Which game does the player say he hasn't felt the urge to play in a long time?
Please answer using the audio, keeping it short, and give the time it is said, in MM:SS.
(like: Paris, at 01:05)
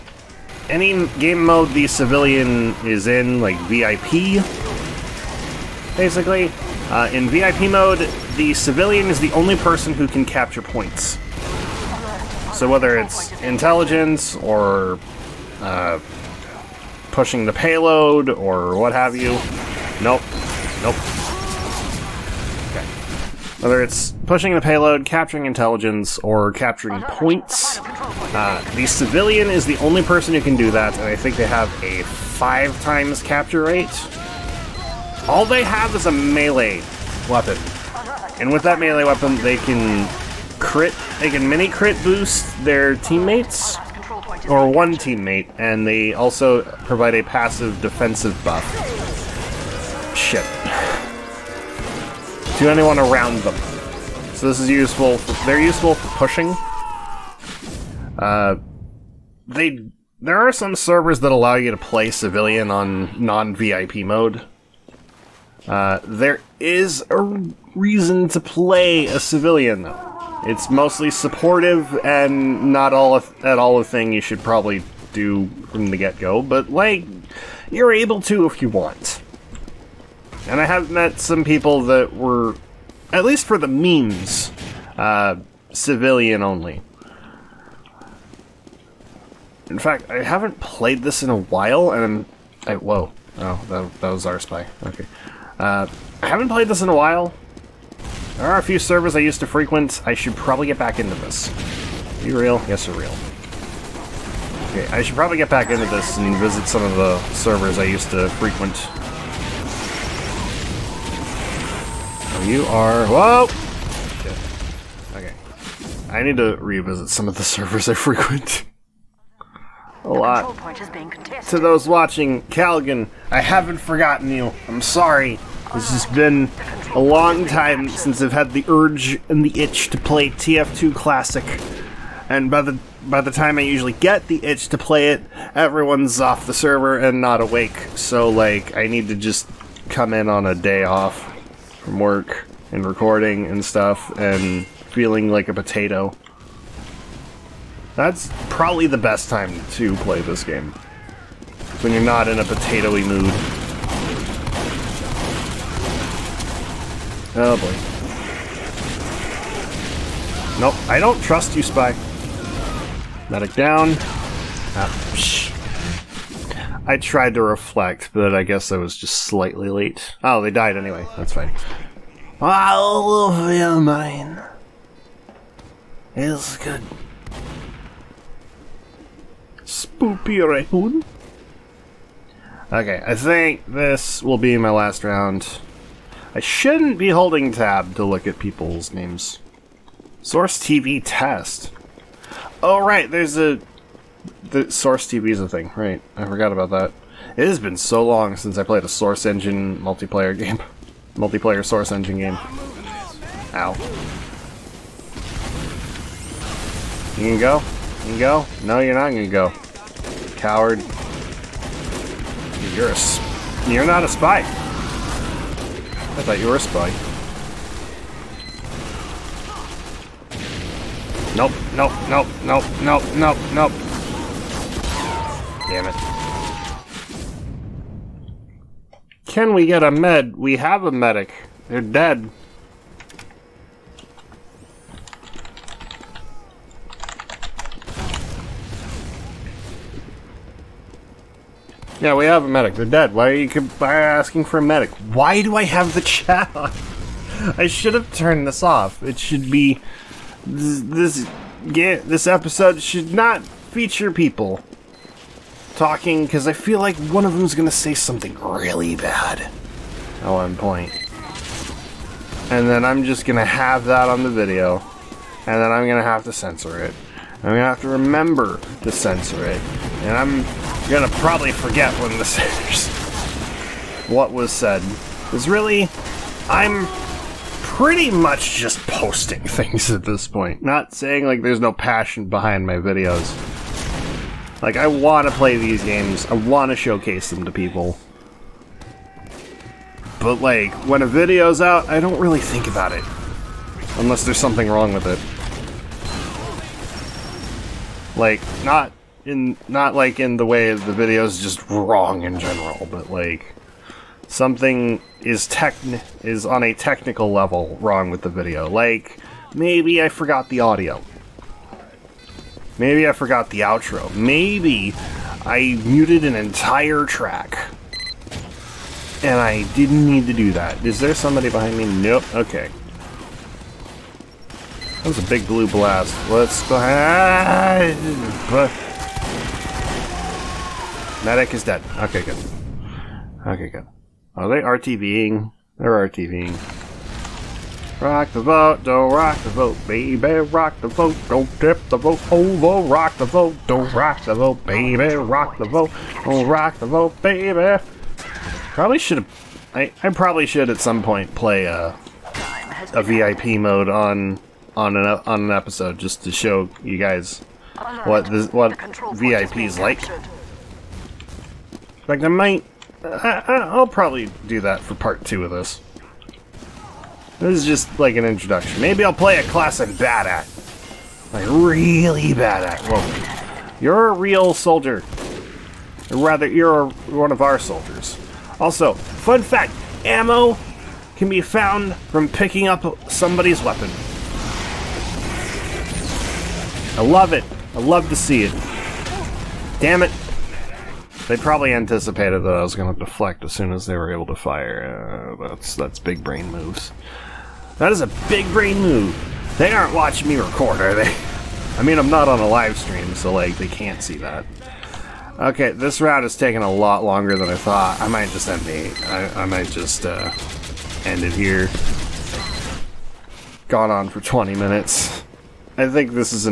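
TF2 Classic, at 02:10.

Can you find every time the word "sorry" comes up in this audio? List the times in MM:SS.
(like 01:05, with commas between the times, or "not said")
02:04.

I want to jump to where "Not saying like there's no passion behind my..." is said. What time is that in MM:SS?
04:40.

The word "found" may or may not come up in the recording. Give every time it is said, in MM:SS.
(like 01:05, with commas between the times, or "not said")
06:21.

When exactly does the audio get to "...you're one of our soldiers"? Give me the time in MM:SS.
06:16.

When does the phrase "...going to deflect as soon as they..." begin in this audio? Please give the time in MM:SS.
06:32.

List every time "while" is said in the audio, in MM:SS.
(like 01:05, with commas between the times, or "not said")
01:31, 01:36.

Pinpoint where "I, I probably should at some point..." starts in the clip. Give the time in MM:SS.
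05:49.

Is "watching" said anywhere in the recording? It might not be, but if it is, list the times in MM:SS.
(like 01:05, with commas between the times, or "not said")
02:01, 06:39.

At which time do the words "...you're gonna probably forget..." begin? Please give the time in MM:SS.
04:30.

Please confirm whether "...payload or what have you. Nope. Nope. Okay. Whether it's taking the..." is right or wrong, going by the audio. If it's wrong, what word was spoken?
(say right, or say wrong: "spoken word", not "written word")
wrong: "pushing", not "taking".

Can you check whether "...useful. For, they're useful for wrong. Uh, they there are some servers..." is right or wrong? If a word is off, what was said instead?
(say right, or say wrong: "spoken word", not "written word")
wrong: "pushing", not "wrong".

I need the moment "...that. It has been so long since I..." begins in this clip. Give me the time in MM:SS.
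03:16.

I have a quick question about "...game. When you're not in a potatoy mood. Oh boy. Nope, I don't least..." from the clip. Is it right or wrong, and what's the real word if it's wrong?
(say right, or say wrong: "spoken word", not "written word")
wrong: "trust", not "least".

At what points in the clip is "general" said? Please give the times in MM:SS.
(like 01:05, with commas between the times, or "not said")
05:02.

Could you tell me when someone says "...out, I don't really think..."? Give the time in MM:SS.
04:51.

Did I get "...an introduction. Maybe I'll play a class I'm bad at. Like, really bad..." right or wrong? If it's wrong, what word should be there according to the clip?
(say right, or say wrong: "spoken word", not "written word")
right.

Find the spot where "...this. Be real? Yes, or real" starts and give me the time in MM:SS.
01:41.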